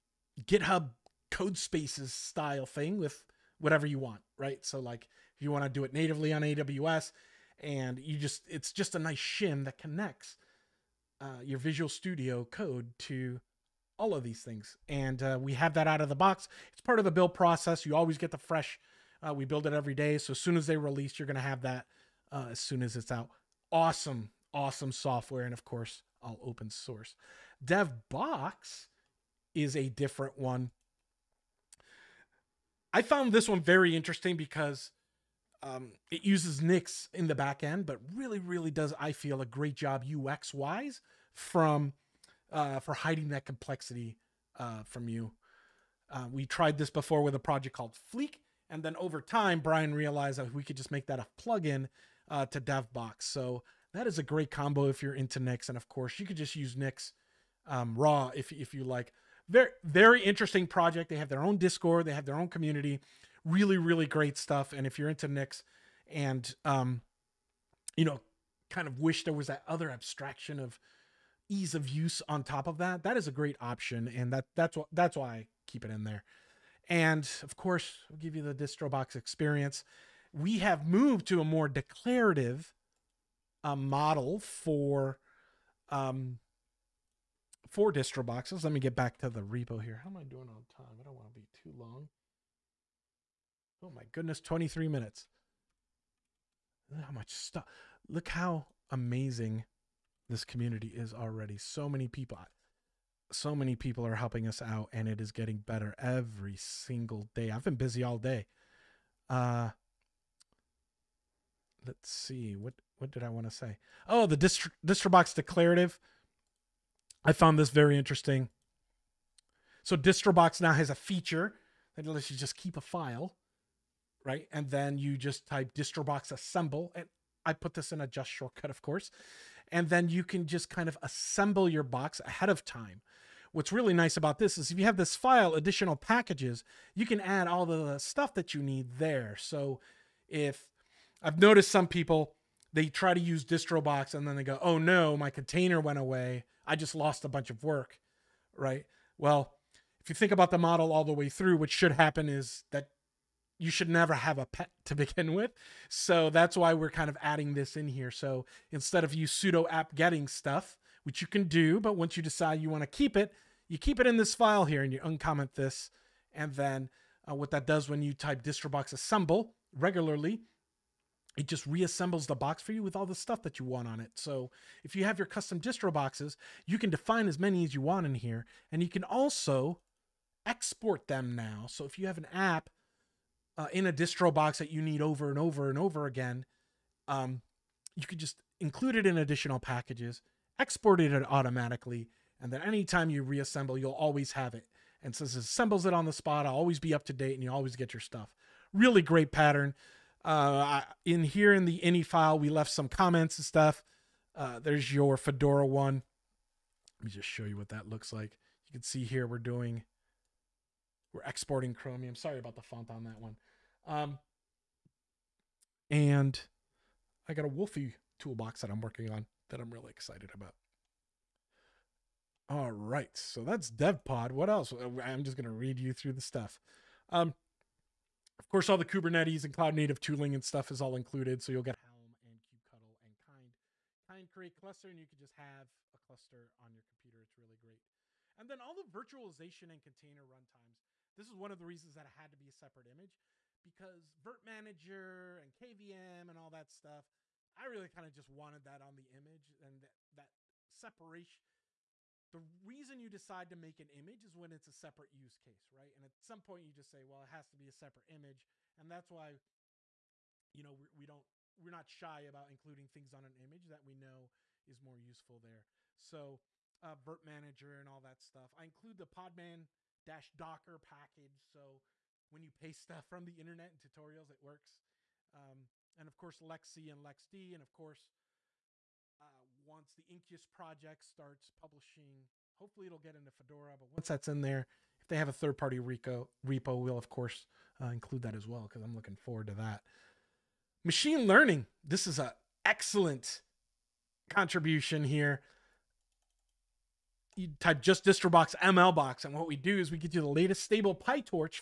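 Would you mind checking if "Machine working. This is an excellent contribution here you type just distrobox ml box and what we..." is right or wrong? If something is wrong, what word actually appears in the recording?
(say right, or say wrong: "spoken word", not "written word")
wrong: "learning", not "working".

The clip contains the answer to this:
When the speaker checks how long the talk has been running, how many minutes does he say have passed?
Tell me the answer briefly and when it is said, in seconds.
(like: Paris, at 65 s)
23, at 94 s.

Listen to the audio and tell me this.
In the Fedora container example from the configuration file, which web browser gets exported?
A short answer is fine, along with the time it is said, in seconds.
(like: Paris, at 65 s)
Chromium, at 211 s.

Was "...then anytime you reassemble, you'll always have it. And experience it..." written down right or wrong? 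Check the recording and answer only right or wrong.
wrong.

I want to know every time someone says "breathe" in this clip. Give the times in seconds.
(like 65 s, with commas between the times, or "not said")
not said.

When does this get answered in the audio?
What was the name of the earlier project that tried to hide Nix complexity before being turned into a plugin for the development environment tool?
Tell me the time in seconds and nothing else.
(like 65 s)
48 s.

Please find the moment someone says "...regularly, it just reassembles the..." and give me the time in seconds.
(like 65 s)
169 s.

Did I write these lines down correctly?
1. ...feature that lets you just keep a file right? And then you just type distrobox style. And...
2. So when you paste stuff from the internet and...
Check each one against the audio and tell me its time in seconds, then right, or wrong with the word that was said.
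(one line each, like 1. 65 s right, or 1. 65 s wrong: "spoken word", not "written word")
1. 120 s wrong: "assemble", not "style"
2. 271 s right.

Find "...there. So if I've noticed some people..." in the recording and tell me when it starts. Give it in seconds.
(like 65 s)
138 s.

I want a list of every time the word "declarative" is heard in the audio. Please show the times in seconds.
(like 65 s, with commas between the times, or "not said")
81 s, 115 s.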